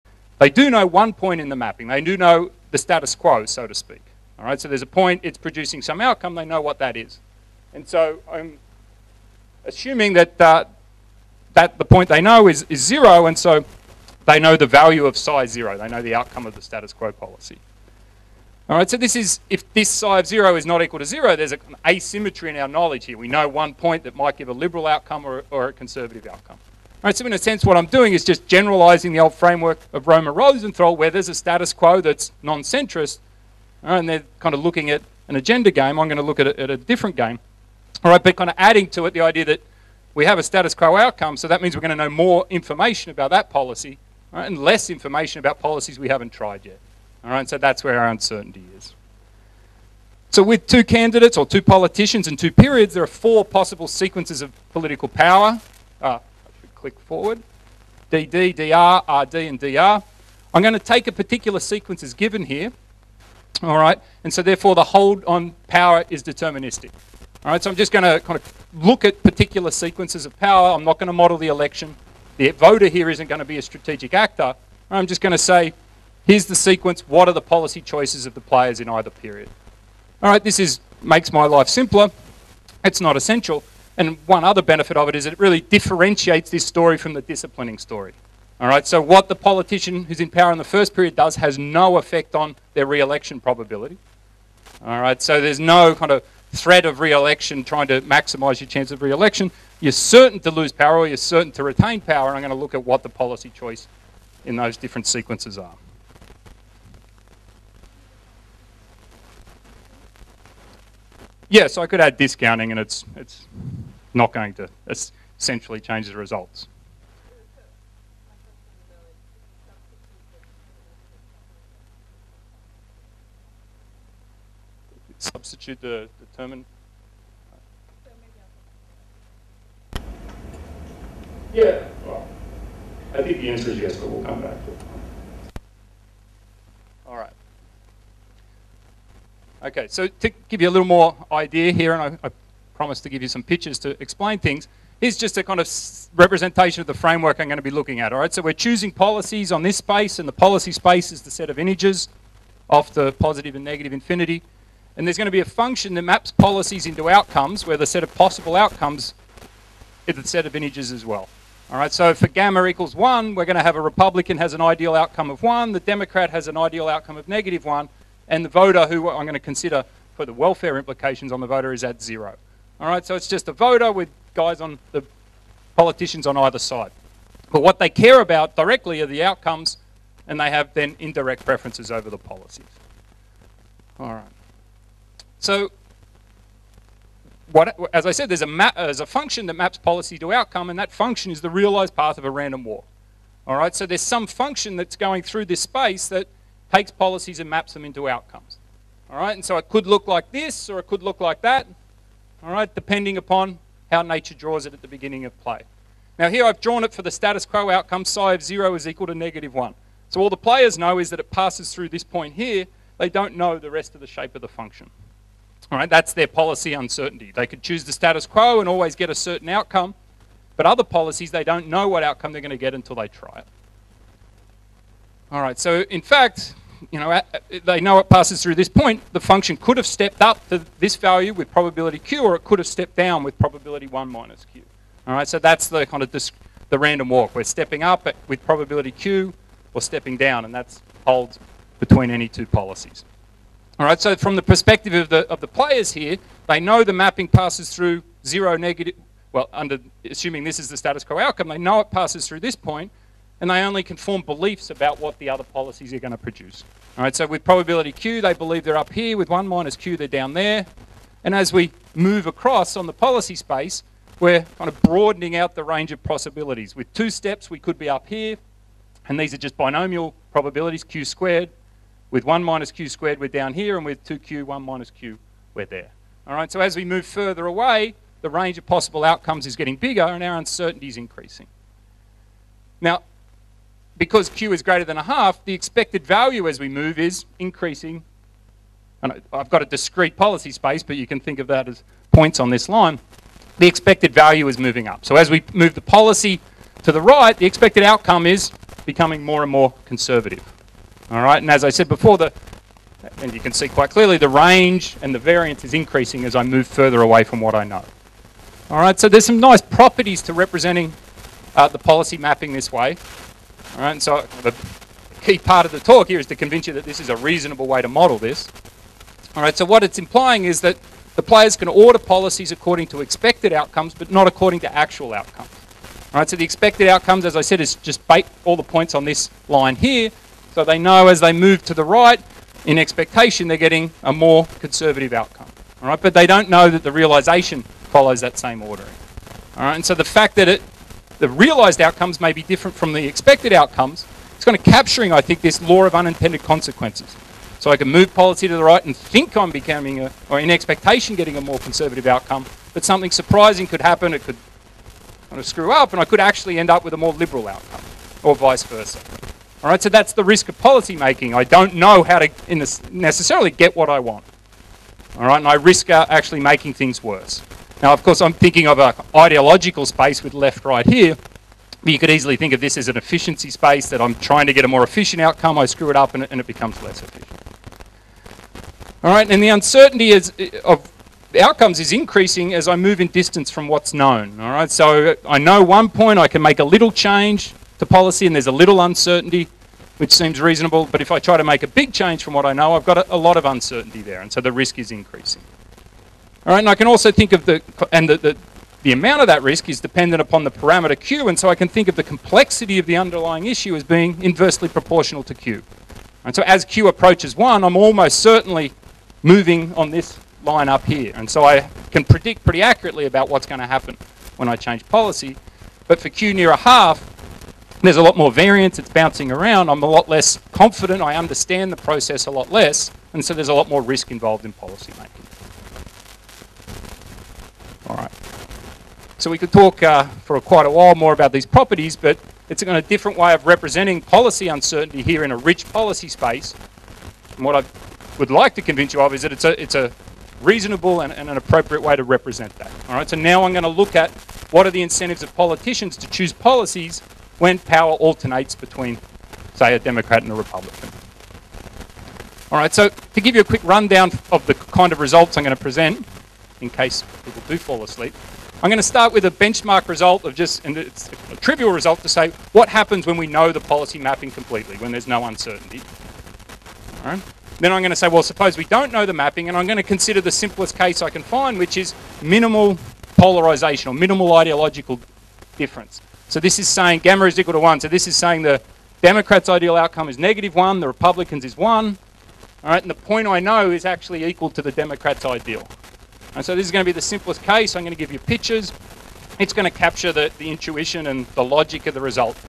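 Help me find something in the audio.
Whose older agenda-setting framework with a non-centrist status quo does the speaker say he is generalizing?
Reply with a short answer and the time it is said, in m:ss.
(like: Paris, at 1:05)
Romer Rosenthal, at 0:30.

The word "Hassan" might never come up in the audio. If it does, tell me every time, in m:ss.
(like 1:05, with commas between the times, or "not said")
not said.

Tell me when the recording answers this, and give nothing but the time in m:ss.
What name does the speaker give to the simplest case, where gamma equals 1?
7:52.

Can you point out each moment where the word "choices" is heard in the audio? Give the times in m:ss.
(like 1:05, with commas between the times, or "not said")
1:17, 1:43.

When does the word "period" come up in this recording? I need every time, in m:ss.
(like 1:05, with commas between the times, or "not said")
0:52, 1:19, 1:30.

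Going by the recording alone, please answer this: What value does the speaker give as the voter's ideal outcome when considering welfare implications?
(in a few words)
0.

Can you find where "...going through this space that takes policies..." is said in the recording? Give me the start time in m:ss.
3:14.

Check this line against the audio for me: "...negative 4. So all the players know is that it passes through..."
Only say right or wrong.
wrong.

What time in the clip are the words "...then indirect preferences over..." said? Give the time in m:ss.
3:00.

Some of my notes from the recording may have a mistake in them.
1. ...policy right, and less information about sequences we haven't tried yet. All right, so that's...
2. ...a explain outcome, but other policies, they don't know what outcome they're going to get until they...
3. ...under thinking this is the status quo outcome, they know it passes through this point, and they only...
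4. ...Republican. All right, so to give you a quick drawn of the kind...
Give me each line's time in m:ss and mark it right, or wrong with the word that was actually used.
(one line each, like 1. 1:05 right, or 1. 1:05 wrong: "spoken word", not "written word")
1. 0:43 wrong: "policies", not "sequences"
2. 3:39 wrong: "certain", not "explain"
3. 4:09 wrong: "assuming", not "thinking"
4. 7:30 wrong: "rundown", not "drawn".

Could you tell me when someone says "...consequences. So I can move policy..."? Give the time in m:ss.
5:46.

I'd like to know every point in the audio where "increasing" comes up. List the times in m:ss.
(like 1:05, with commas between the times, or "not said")
4:40, 4:47, 5:05, 6:21, 6:34.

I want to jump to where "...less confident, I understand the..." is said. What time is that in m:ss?
7:00.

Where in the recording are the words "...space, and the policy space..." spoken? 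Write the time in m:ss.
2:29.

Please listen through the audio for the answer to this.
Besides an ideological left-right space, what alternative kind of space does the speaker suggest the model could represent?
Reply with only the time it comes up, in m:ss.
6:12.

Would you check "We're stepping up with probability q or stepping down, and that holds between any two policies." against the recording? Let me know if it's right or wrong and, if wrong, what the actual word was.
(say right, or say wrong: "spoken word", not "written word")
right.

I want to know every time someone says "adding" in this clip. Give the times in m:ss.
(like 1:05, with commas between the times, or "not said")
0:38.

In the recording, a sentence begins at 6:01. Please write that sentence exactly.
I don't know how to necessarily get what I want.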